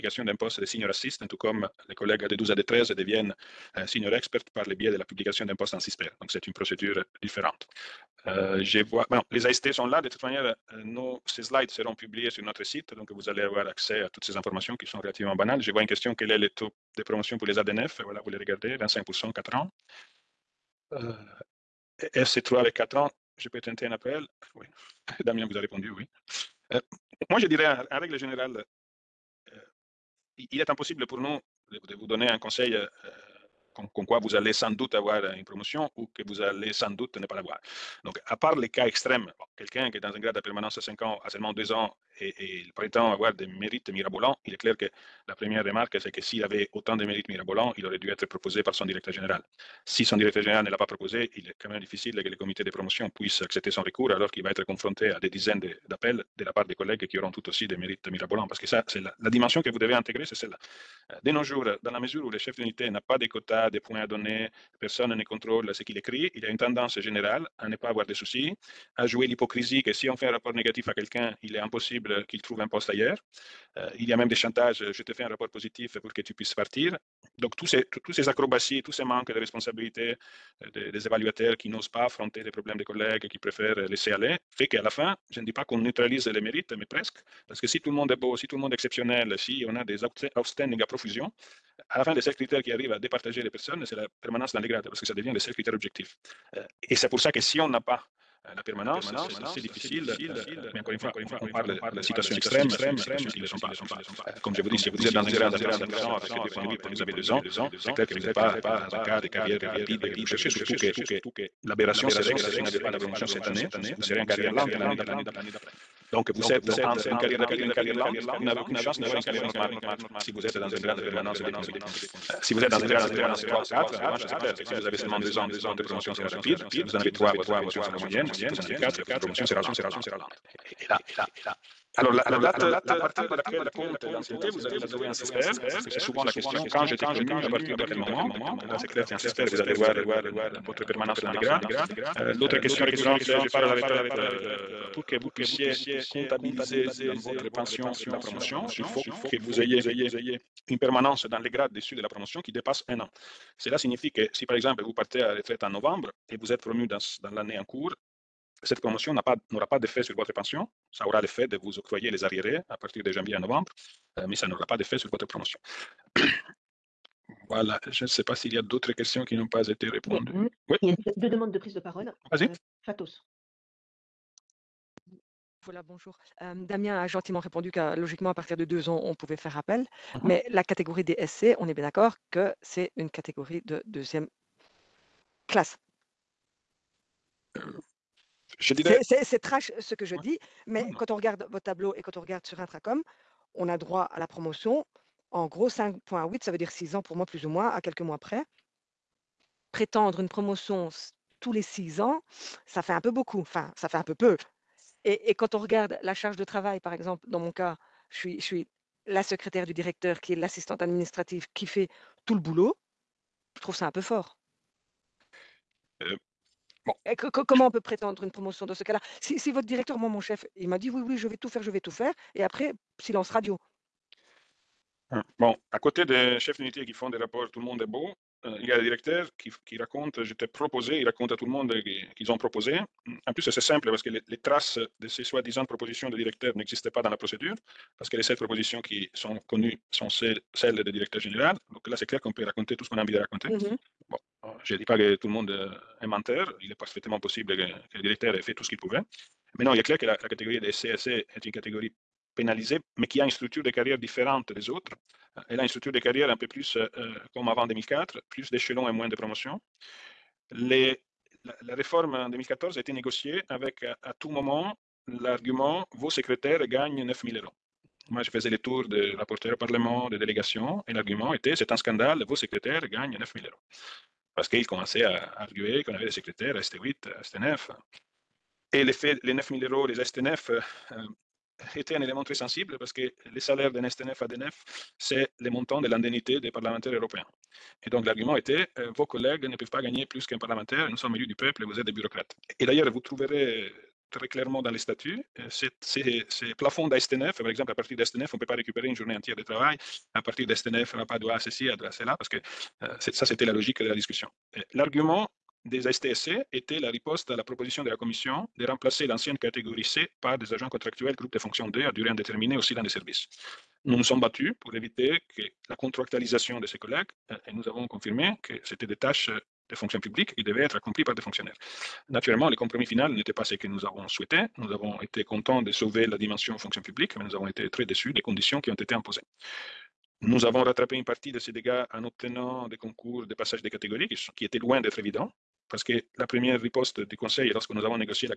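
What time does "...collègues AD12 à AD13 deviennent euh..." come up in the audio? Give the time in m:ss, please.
0:01.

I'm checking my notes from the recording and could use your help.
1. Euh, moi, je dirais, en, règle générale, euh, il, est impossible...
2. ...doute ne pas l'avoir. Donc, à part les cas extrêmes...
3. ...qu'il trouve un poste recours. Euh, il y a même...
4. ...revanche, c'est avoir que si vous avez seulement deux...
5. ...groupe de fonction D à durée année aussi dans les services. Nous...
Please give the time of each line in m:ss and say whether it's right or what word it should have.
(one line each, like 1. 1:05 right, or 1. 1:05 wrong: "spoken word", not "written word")
1. 0:26 right
2. 0:36 right
3. 1:12 wrong: "ailleurs", not "recours"
4. 2:03 wrong: "clair", not "avoir"
5. 5:11 wrong: "indéterminée", not "année".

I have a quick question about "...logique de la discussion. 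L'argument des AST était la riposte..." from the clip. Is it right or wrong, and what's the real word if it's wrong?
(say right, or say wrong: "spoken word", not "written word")
wrong: "STSC", not "AST".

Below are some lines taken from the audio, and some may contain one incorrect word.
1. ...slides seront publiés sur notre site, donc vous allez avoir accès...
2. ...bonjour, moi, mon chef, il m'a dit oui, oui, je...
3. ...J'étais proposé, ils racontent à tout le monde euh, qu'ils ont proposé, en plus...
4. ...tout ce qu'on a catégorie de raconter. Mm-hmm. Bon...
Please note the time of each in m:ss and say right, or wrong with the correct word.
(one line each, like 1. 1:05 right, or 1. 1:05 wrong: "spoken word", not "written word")
1. 0:11 right
2. 3:39 wrong: "directeur", not "bonjour"
3. 3:50 right
4. 4:02 wrong: "envie", not "catégorie".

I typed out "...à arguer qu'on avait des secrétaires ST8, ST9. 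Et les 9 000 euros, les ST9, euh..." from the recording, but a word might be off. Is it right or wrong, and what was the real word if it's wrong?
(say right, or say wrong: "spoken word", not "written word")
right.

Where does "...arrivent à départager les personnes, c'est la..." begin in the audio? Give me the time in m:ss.
1:32.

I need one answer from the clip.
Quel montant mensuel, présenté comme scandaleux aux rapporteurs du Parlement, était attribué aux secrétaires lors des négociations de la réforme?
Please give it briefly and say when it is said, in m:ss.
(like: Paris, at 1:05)
9000 euros, at 4:27.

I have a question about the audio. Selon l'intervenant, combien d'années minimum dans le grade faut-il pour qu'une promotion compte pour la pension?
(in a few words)
1 an.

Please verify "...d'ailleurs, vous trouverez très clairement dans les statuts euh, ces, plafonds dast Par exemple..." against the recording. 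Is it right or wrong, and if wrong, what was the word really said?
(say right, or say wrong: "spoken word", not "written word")
right.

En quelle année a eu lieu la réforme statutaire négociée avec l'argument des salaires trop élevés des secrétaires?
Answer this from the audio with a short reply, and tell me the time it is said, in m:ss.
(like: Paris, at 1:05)
2014, at 4:22.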